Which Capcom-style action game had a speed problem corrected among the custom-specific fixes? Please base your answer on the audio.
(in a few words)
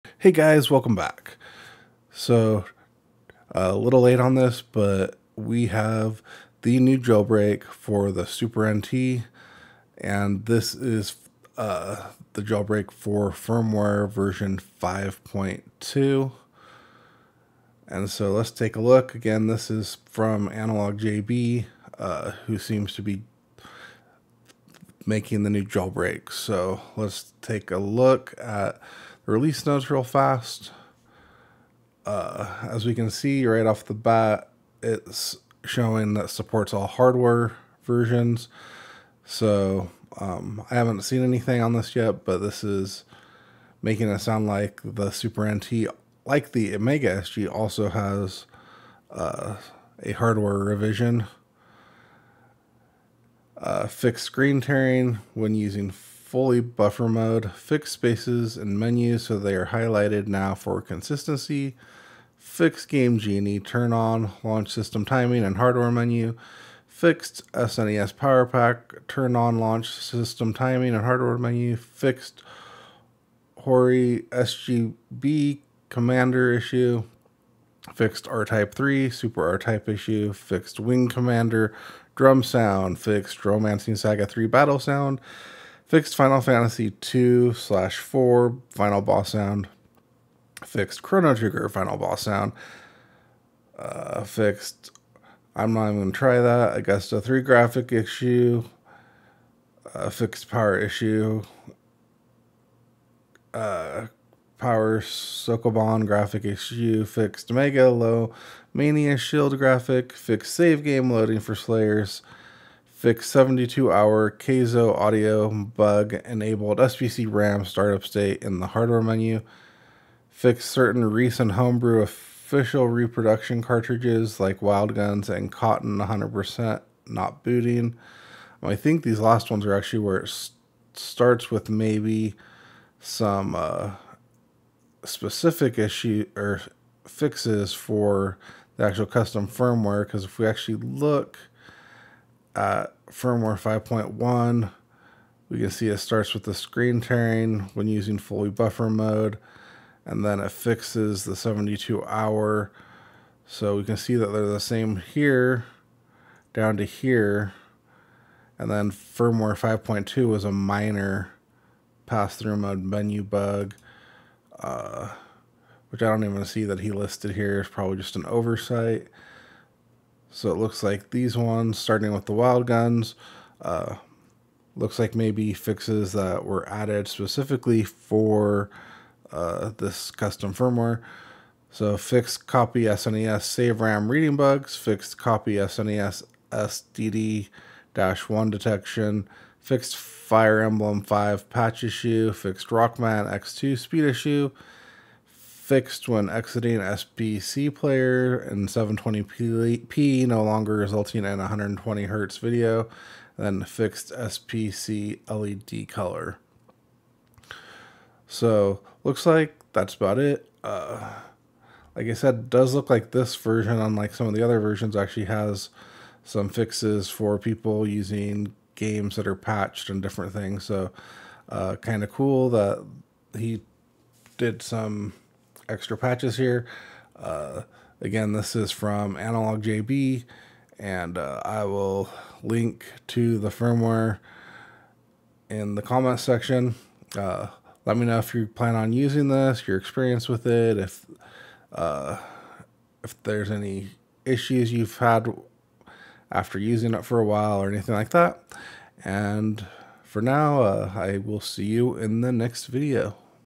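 Rockman X2.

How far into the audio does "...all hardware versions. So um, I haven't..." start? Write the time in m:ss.
0:36.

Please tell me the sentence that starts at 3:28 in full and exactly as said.
So looks like that's about it.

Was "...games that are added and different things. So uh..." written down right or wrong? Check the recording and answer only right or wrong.
wrong.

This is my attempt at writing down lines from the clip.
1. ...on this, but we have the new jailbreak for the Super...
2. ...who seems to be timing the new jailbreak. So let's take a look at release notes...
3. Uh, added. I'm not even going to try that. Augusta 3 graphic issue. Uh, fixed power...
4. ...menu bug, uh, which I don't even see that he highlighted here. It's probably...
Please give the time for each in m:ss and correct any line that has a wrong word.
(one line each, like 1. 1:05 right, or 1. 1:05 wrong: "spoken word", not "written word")
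1. 0:04 right
2. 0:22 wrong: "making", not "timing"
3. 1:33 wrong: "fixed", not "added"
4. 2:42 wrong: "listed", not "highlighted".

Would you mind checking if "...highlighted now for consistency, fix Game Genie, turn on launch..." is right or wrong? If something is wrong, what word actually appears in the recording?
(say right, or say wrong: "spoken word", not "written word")
right.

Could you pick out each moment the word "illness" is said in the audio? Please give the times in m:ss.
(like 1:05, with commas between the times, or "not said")
not said.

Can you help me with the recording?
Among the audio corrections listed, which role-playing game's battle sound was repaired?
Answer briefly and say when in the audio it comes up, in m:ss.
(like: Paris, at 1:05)
Romancing Saga 3, at 1:23.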